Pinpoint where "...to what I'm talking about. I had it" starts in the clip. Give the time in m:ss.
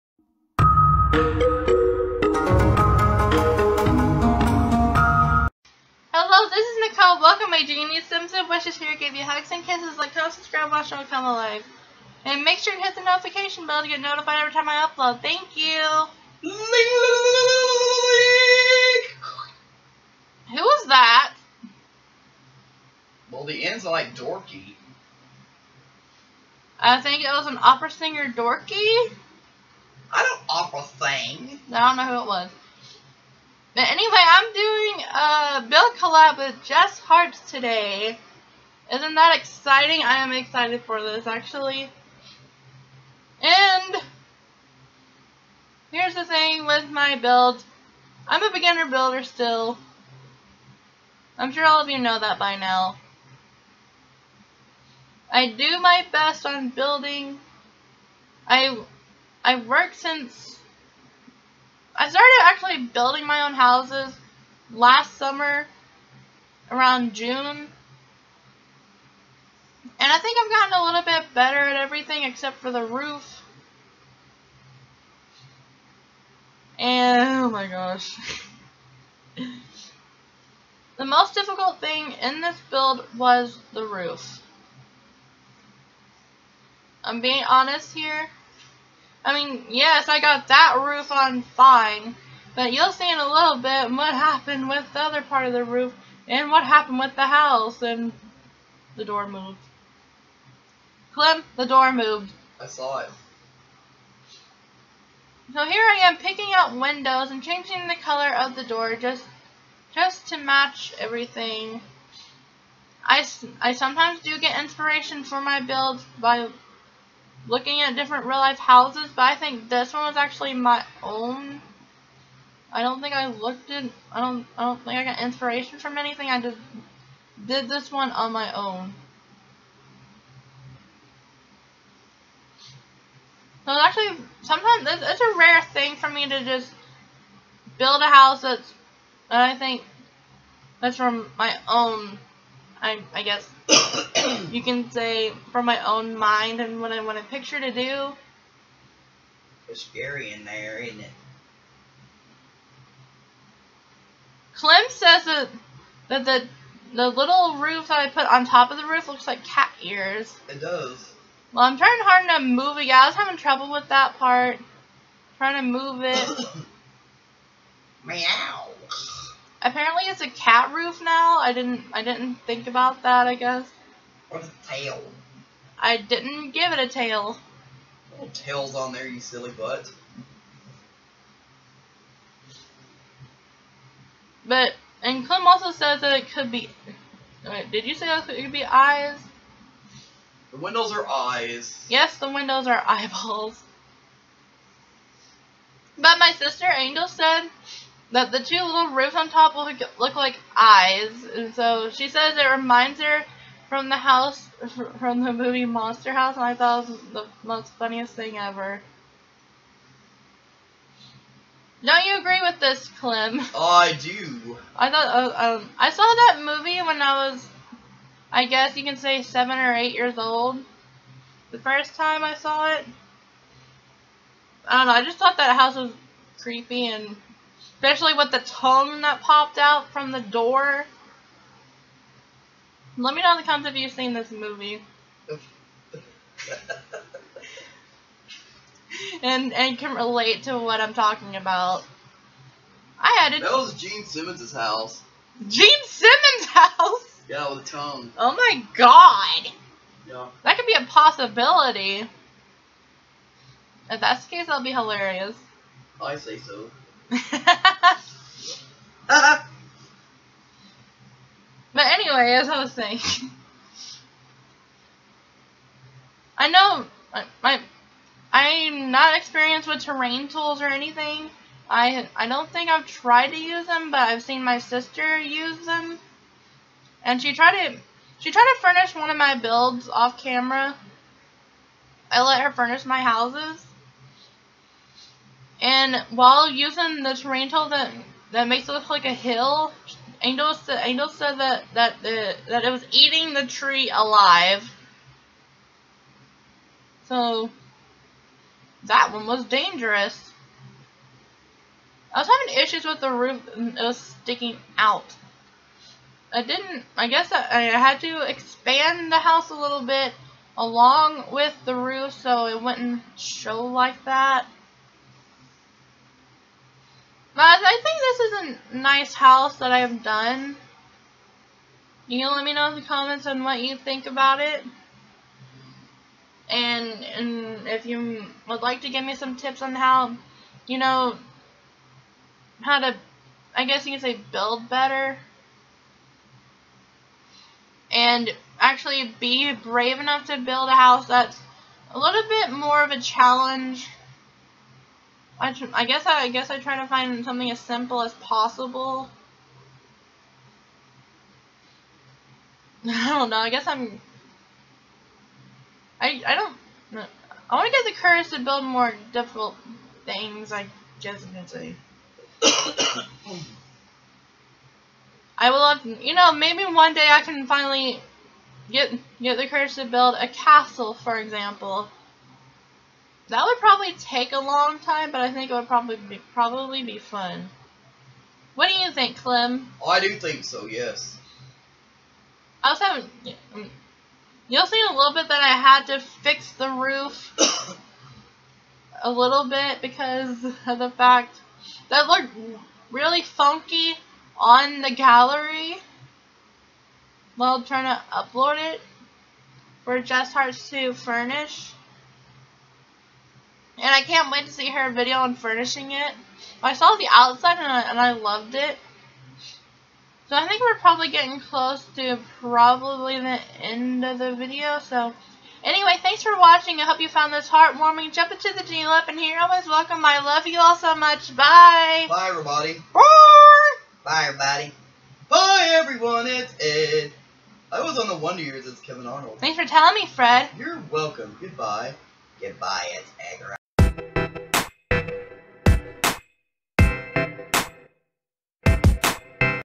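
4:00.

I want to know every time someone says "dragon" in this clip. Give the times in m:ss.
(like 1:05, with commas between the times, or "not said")
not said.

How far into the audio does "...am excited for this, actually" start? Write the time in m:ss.
0:40.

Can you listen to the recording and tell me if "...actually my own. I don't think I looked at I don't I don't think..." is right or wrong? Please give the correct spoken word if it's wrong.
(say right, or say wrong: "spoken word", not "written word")
right.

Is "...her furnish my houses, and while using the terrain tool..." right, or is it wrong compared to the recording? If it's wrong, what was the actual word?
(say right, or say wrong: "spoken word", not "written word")
right.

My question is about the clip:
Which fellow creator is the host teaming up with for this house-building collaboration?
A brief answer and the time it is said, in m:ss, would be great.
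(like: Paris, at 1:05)
Jess Hart, at 0:36.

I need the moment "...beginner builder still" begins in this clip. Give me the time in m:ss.
0:48.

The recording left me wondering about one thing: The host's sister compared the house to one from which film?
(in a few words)
Monster House.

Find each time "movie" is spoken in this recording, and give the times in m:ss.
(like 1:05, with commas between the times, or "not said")
3:25, 3:36, 3:54.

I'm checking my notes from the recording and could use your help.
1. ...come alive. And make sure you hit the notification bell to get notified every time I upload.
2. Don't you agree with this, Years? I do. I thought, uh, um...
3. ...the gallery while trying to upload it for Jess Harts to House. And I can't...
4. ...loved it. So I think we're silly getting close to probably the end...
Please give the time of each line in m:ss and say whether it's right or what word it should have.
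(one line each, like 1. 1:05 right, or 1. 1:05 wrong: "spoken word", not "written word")
1. 0:11 right
2. 3:31 wrong: "Clem", not "Years"
3. 6:34 wrong: "Furnish", not "House"
4. 6:48 wrong: "probably", not "silly".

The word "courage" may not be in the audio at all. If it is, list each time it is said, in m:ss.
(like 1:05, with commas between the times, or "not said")
5:57, 6:09.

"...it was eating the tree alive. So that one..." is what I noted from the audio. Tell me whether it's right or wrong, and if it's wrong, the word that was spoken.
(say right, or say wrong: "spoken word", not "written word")
right.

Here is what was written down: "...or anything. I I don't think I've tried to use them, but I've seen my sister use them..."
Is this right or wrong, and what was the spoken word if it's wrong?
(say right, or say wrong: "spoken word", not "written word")
right.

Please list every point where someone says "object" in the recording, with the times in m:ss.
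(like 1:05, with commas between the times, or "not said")
not said.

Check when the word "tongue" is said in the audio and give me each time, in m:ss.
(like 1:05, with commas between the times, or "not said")
3:48, 4:07.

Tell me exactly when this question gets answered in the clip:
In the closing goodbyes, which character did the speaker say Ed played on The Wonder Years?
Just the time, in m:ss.
7:08.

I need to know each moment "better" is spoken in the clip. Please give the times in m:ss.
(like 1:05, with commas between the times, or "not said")
1:11, 5:34.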